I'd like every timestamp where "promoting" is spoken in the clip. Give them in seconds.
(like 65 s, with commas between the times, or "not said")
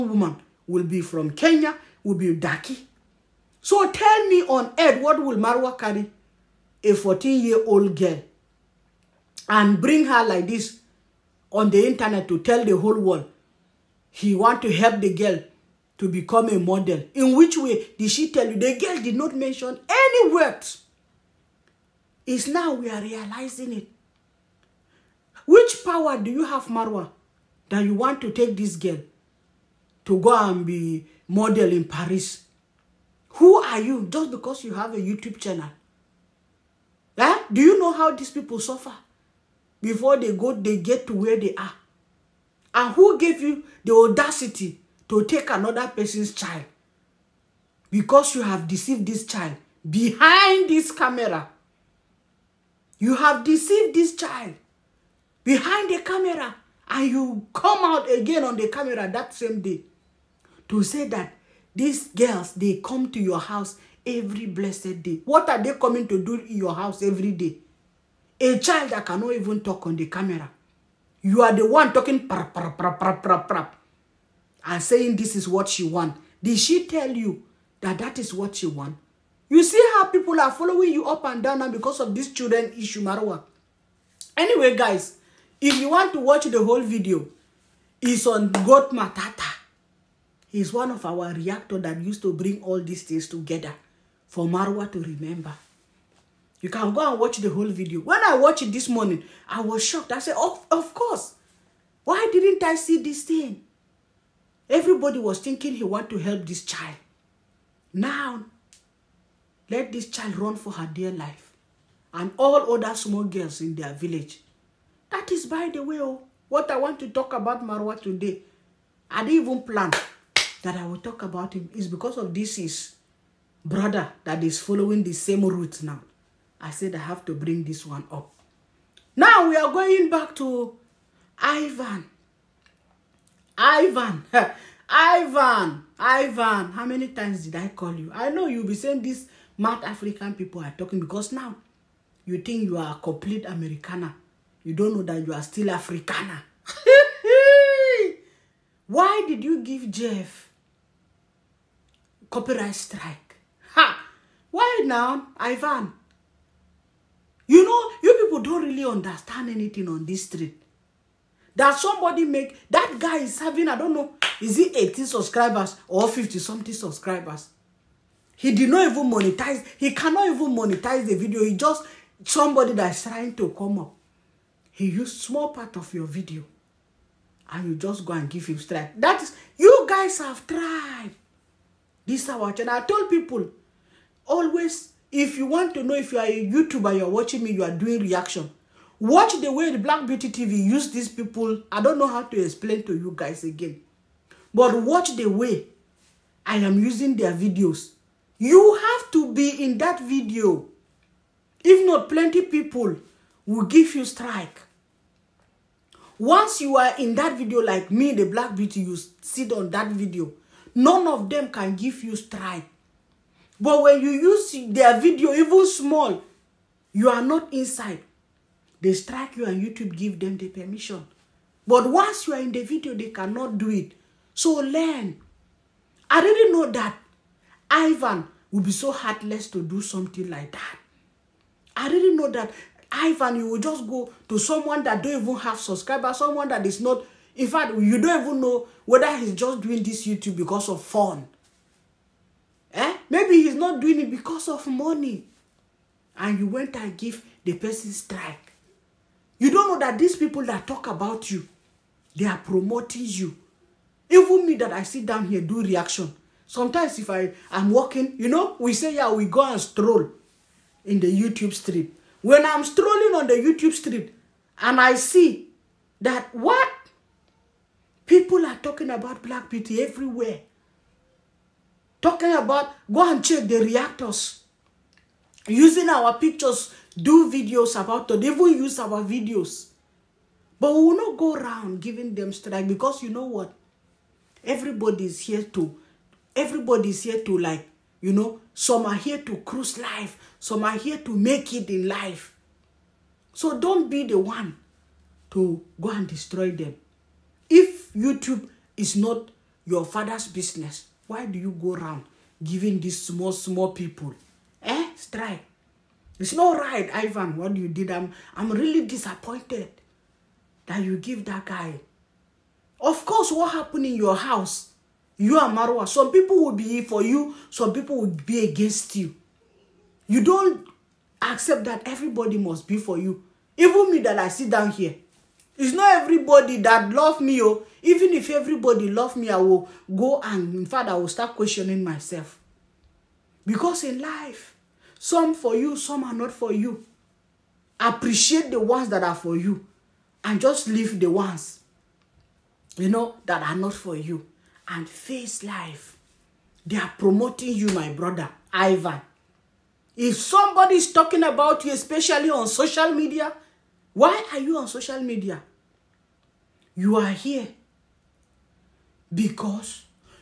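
252 s, 346 s.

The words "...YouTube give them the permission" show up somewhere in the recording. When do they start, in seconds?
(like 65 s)
219 s.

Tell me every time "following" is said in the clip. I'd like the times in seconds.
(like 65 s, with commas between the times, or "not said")
80 s, 124 s.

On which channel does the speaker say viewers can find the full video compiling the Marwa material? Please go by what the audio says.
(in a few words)
Goat Matata.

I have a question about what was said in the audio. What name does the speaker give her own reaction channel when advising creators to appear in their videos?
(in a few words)
Black Beauty TV.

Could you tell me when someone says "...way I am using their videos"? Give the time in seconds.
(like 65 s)
195 s.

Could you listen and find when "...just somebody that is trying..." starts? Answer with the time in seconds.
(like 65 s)
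171 s.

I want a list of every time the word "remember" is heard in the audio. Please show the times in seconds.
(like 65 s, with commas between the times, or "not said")
94 s.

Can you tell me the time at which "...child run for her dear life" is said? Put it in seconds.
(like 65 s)
110 s.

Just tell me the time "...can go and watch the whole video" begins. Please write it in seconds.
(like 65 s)
96 s.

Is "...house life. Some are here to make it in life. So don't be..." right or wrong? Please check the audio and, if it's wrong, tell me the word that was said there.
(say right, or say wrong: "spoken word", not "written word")
wrong: "cruise", not "house".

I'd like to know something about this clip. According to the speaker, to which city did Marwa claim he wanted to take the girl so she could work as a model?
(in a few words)
Paris.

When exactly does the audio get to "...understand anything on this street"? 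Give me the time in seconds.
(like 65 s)
158 s.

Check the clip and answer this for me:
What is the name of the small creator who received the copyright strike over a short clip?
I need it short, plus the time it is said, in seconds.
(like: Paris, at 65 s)
Jeff, at 149 s.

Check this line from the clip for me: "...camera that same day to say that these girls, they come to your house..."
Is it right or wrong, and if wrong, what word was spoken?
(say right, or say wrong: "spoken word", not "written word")
right.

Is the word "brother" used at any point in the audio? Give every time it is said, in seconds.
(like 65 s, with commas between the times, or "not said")
123 s, 347 s.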